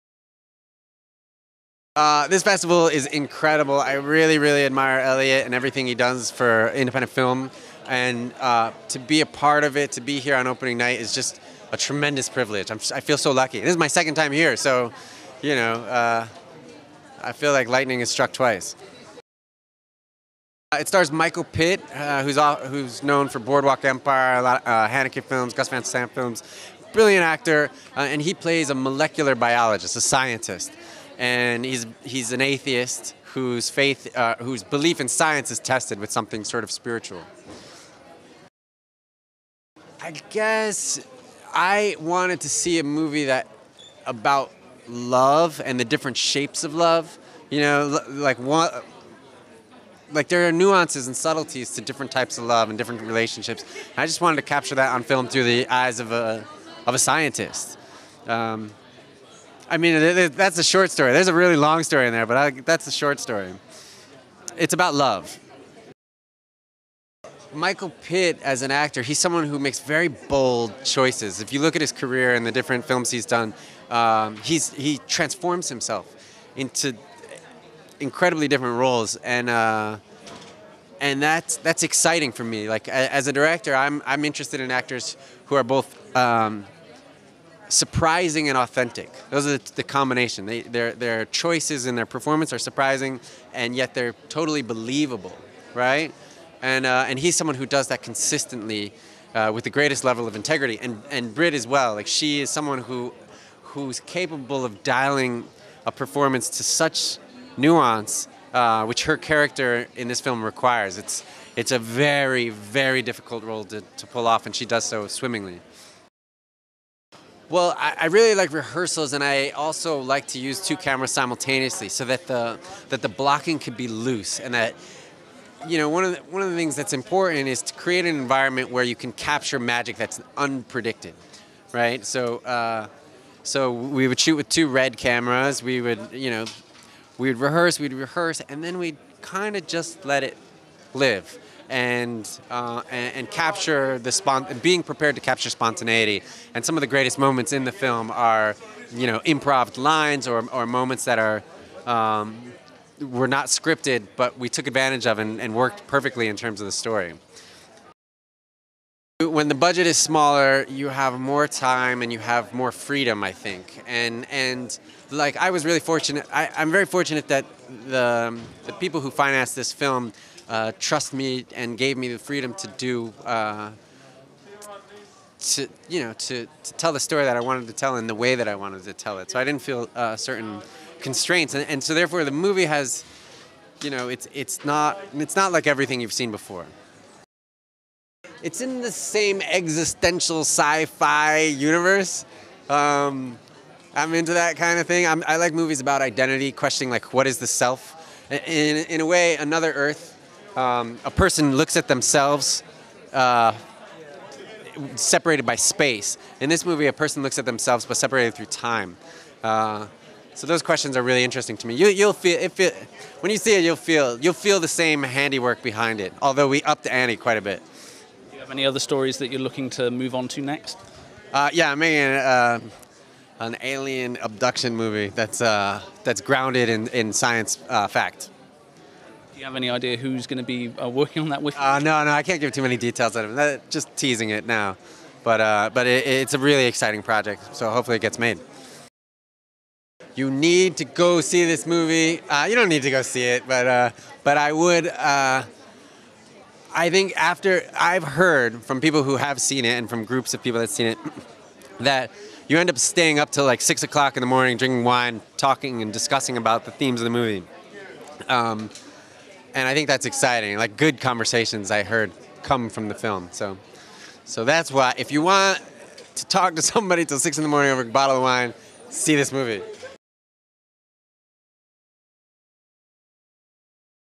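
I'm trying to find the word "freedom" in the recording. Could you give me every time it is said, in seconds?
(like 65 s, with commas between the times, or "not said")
162 s, 172 s.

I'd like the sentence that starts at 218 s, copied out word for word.
Do you have any other stories that you're looking to move on to next?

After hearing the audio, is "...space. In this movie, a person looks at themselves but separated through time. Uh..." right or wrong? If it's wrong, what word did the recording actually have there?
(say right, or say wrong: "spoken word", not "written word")
right.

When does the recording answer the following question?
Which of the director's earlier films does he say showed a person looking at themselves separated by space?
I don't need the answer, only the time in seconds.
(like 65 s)
199 s.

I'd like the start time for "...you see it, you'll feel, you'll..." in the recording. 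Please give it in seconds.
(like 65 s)
213 s.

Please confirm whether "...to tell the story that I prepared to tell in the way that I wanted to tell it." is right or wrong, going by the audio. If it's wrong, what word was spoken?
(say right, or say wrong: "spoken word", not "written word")
wrong: "wanted", not "prepared".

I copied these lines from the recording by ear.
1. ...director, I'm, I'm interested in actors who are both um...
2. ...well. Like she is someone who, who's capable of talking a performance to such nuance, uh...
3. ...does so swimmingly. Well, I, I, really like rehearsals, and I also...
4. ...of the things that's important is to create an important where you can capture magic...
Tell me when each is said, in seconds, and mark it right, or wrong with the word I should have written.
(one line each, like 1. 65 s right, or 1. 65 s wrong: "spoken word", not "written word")
1. 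83 s right
2. 101 s wrong: "dialing", not "talking"
3. 114 s right
4. 126 s wrong: "environment", not "important".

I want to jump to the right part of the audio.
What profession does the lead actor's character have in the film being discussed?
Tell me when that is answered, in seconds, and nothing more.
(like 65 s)
28 s.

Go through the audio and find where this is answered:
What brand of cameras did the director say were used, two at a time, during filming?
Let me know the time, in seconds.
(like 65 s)
134 s.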